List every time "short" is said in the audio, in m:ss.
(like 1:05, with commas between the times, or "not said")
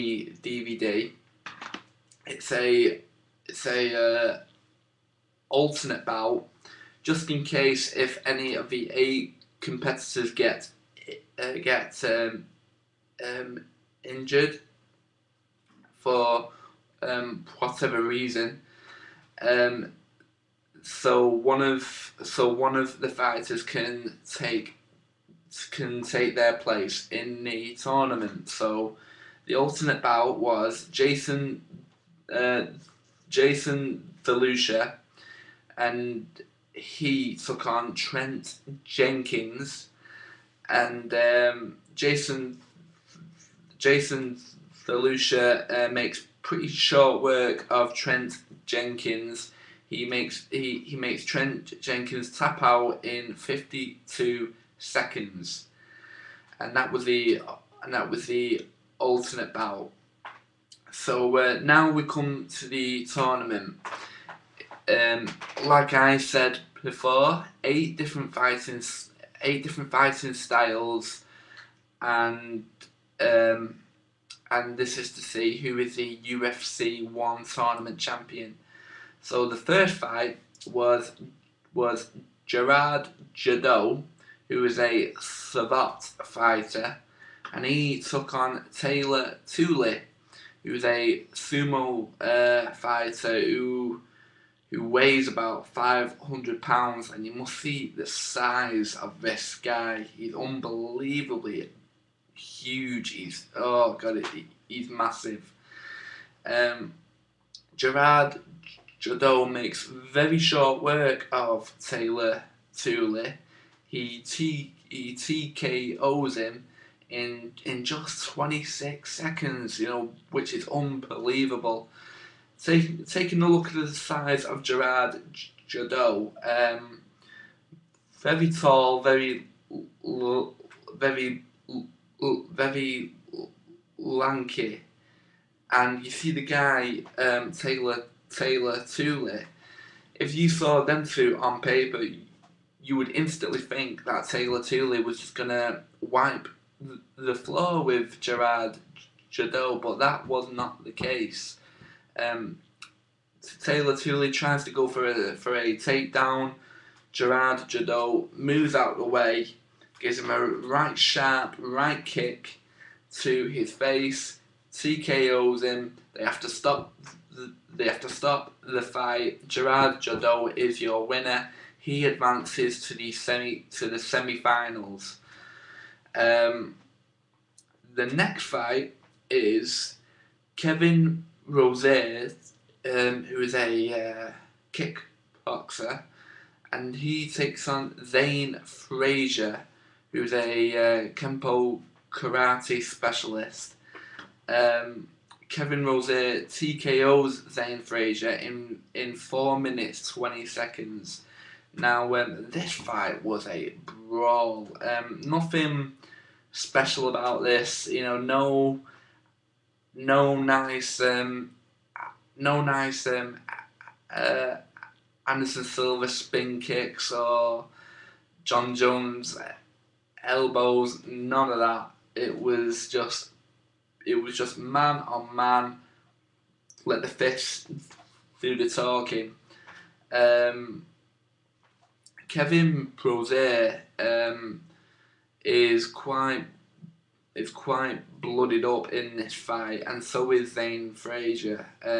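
0:46, 1:50.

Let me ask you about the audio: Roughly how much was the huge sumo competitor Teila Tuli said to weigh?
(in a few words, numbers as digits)
500 pounds.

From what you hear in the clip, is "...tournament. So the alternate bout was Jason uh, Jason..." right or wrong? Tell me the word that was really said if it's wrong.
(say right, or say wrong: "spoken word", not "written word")
right.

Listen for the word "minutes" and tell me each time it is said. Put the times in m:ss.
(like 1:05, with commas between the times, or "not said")
3:19.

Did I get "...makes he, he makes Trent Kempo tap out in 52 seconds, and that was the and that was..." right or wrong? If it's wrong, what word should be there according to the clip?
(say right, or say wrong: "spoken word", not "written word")
wrong: "Jenkins", not "Kempo".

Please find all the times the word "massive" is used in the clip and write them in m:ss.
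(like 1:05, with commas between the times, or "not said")
1:44.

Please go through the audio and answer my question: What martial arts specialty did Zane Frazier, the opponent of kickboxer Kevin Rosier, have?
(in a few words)
Kempo karate.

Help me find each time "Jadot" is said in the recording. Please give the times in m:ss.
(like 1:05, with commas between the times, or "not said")
1:23, 1:48, 2:05, 2:29, 2:37, 2:50.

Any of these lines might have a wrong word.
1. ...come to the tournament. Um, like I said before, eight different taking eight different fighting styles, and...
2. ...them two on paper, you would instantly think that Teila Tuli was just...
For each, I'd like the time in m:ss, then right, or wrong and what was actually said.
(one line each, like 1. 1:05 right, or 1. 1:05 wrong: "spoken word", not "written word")
1. 1:02 wrong: "fighting", not "taking"
2. 2:20 right.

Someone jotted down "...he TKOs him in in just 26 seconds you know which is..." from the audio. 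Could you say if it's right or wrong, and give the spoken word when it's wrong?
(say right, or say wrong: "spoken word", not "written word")
right.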